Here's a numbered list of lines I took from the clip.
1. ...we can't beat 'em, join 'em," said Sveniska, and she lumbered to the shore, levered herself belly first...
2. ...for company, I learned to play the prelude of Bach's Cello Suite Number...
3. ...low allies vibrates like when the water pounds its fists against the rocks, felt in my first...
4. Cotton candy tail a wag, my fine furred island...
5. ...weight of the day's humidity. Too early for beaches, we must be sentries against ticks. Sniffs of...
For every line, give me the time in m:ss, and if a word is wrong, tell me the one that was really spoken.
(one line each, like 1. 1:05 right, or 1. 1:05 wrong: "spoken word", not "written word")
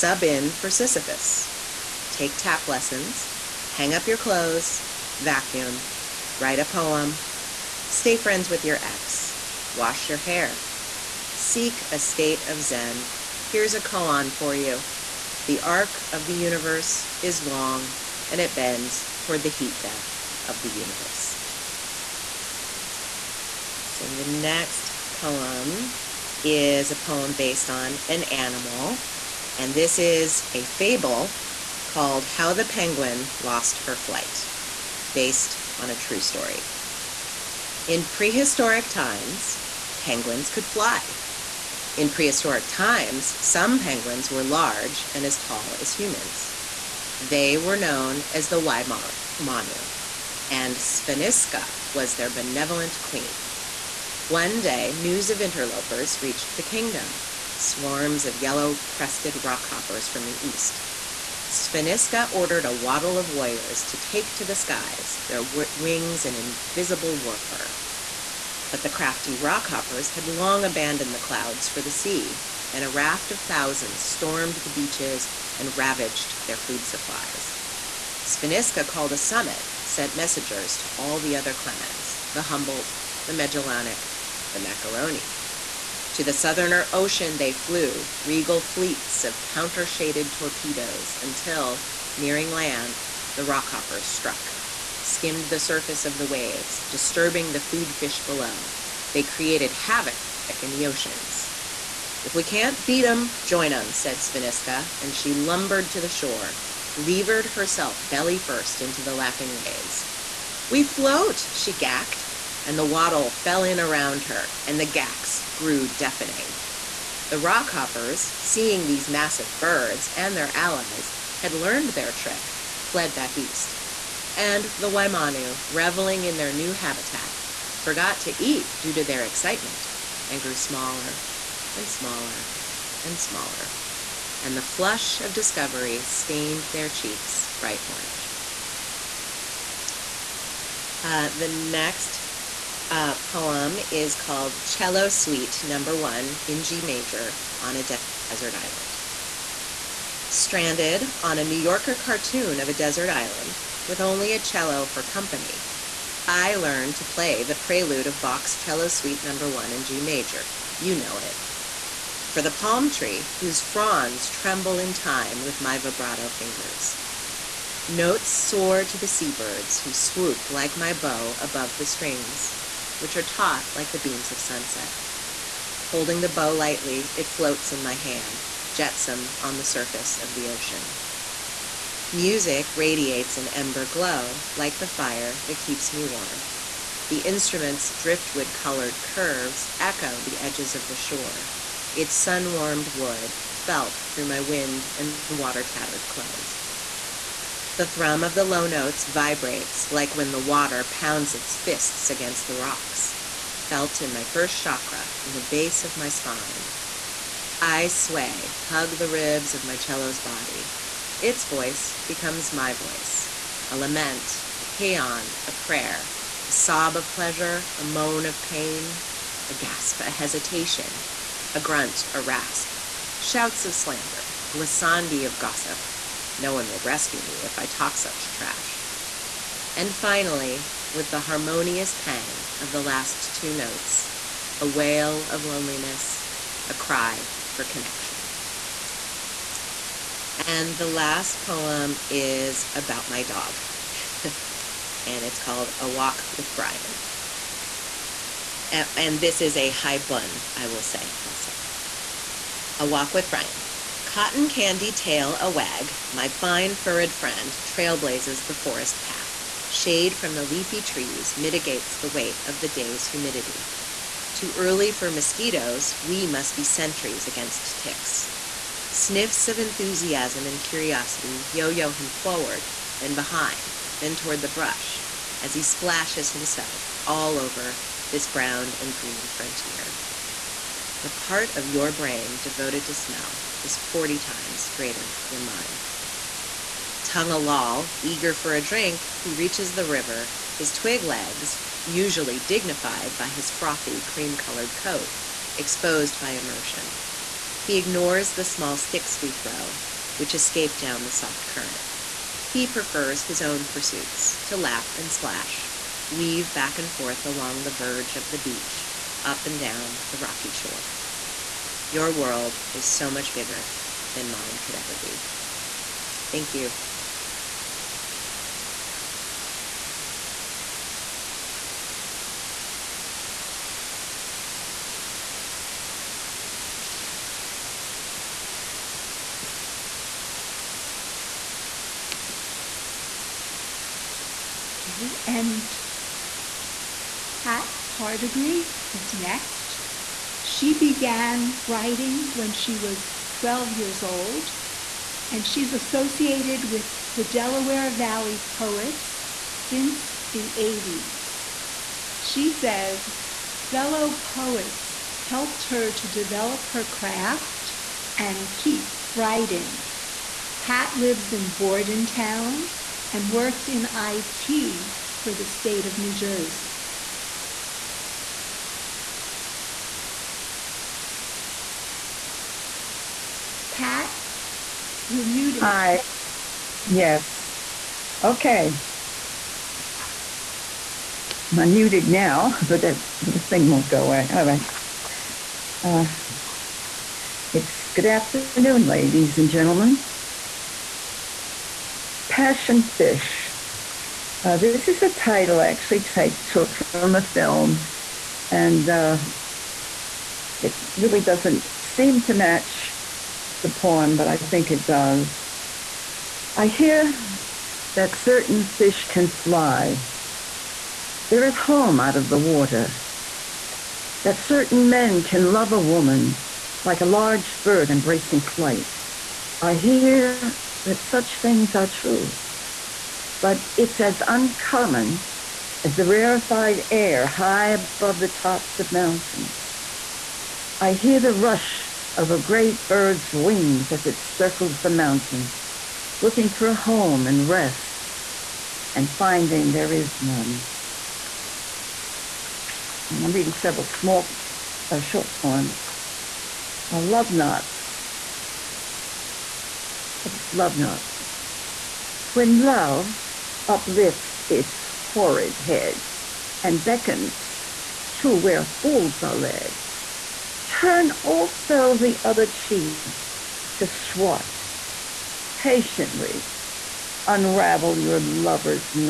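1. 1:42 right
2. 2:34 right
3. 3:18 wrong: "notes", not "allies"
4. 4:14 wrong: "friend", not "island"
5. 4:22 wrong: "mosquitoes", not "beaches".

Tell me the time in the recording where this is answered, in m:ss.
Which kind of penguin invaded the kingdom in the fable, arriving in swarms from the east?
0:58.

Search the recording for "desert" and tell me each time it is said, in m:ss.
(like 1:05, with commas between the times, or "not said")
2:28, 2:32.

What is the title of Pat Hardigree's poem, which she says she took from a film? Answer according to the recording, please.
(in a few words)
Passion Fish.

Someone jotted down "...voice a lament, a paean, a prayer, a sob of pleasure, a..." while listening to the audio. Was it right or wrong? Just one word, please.
right.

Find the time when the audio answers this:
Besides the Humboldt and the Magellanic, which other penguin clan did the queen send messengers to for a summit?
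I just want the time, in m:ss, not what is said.
1:24.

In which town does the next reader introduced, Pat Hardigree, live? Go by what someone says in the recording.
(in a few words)
Bordentown.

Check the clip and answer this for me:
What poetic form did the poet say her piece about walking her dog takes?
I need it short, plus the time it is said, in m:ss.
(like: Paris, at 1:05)
Haibun, at 4:09.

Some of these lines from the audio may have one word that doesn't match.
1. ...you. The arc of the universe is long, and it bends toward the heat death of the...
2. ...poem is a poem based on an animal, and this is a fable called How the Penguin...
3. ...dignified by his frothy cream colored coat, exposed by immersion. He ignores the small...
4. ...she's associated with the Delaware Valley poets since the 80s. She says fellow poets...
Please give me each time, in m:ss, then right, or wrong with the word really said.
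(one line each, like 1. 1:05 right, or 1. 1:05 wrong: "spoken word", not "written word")
1. 0:14 right
2. 0:25 right
3. 4:52 right
4. 5:45 right.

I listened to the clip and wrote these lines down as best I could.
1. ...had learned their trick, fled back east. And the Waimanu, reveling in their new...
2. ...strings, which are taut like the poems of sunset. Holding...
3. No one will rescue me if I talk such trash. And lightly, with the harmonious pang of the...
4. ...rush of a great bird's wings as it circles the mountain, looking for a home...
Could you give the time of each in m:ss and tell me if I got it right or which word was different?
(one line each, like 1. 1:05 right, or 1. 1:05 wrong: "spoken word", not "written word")
1. 2:01 right
2. 2:51 wrong: "beams", not "poems"
3. 3:46 wrong: "finally", not "lightly"
4. 7:11 right.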